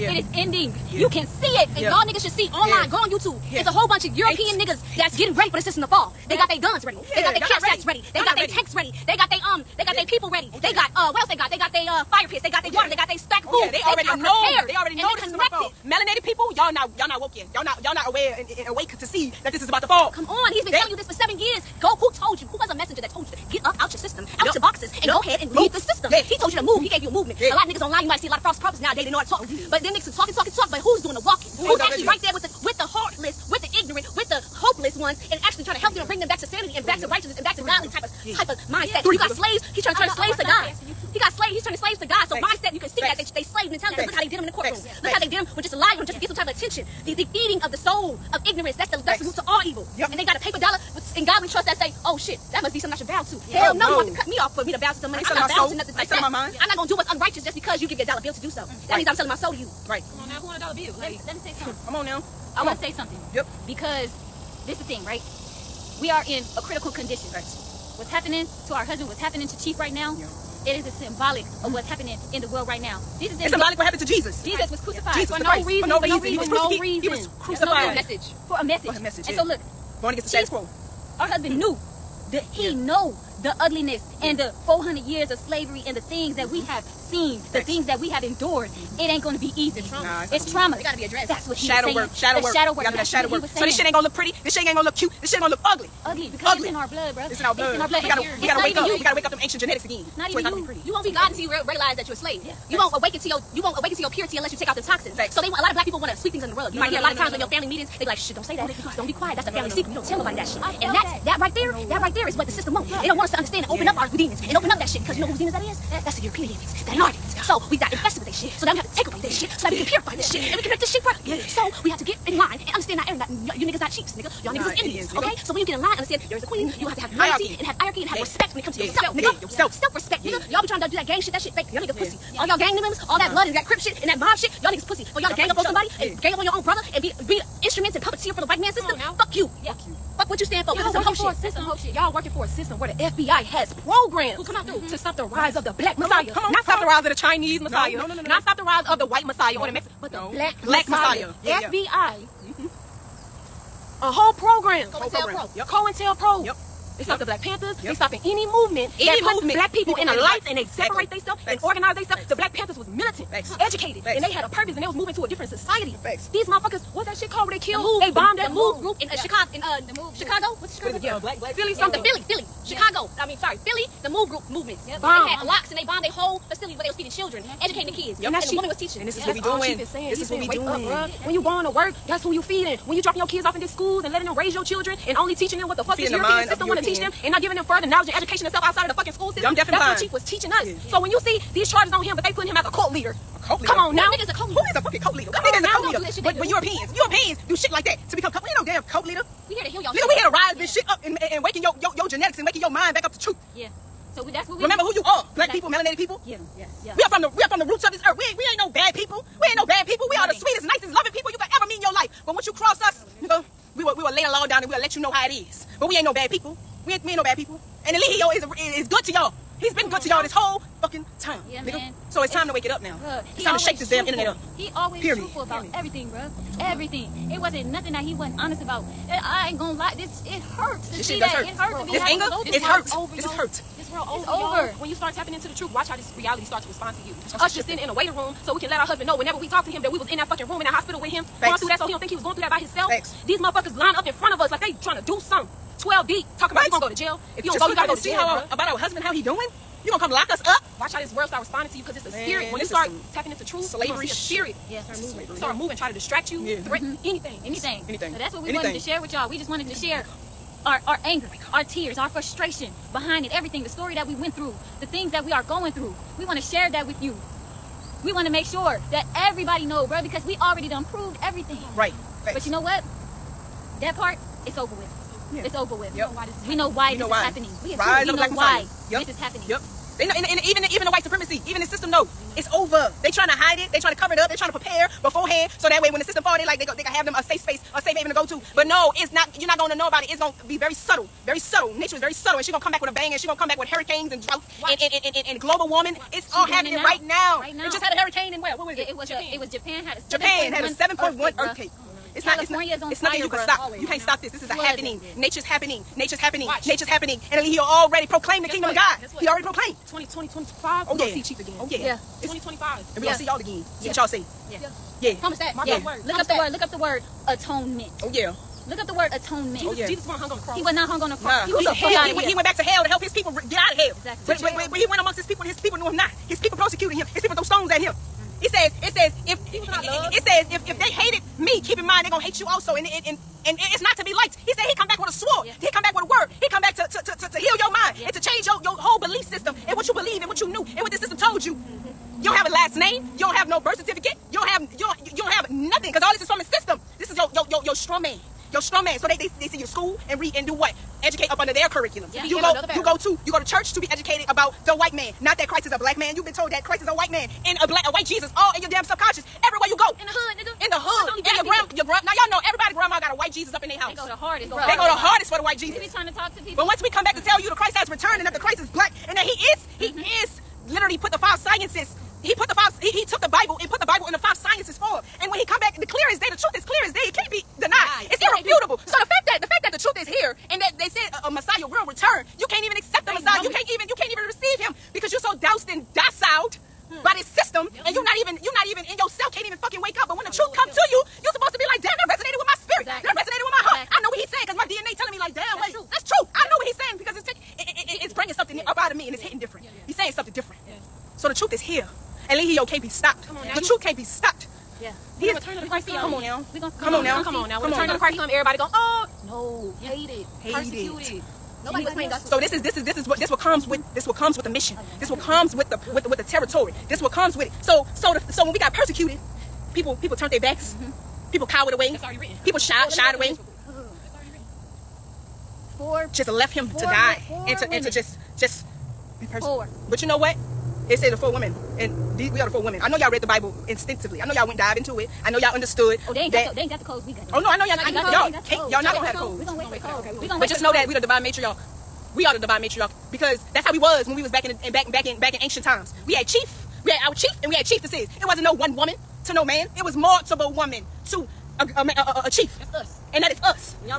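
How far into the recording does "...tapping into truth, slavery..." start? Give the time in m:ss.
4:13.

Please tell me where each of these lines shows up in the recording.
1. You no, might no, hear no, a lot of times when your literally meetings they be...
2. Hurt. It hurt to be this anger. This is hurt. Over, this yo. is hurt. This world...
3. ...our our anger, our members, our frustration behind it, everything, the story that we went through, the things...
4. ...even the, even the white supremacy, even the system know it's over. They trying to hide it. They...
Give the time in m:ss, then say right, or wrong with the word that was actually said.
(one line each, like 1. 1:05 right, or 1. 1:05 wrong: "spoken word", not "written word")
1. 1:46 wrong: "family", not "literally"
2. 3:51 right
3. 4:20 wrong: "tears", not "members"
4. 4:40 right.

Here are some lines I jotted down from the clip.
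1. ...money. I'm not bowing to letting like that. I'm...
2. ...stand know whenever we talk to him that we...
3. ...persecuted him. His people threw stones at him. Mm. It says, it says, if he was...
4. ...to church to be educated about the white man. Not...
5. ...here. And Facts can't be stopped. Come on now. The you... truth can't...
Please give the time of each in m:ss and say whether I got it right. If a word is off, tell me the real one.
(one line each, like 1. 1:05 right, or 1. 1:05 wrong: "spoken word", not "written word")
1. 0:55 wrong: "nothing", not "letting"
2. 3:58 wrong: "husband", not "stand"
3. 5:26 right
4. 5:53 right
5. 6:41 wrong: "Eligio", not "Facts".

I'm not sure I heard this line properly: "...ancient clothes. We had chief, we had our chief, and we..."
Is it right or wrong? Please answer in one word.
wrong.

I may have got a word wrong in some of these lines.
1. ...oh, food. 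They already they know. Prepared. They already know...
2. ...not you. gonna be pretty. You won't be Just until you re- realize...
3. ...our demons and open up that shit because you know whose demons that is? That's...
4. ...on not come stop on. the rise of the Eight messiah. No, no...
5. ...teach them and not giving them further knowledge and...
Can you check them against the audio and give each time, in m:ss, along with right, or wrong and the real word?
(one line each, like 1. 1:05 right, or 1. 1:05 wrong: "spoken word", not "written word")
1. 0:13 right
2. 1:40 wrong: "God", not "Just"
3. 1:53 right
4. 2:26 wrong: "Chinese", not "Eight"
5. 3:06 right.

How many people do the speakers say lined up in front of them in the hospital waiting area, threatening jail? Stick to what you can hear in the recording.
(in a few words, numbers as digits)
12.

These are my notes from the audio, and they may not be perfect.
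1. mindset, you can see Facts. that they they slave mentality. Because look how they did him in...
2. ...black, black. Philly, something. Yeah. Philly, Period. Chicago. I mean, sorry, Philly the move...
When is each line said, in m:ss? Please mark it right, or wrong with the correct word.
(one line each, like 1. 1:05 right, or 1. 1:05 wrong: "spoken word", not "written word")
1. 0:42 right
2. 2:51 wrong: "Philly", not "Period".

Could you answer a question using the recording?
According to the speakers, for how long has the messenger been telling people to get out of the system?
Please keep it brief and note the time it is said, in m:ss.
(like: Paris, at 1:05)
7 years, at 0:21.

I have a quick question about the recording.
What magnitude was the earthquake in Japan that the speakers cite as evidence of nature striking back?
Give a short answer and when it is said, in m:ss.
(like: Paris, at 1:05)
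7.1, at 5:00.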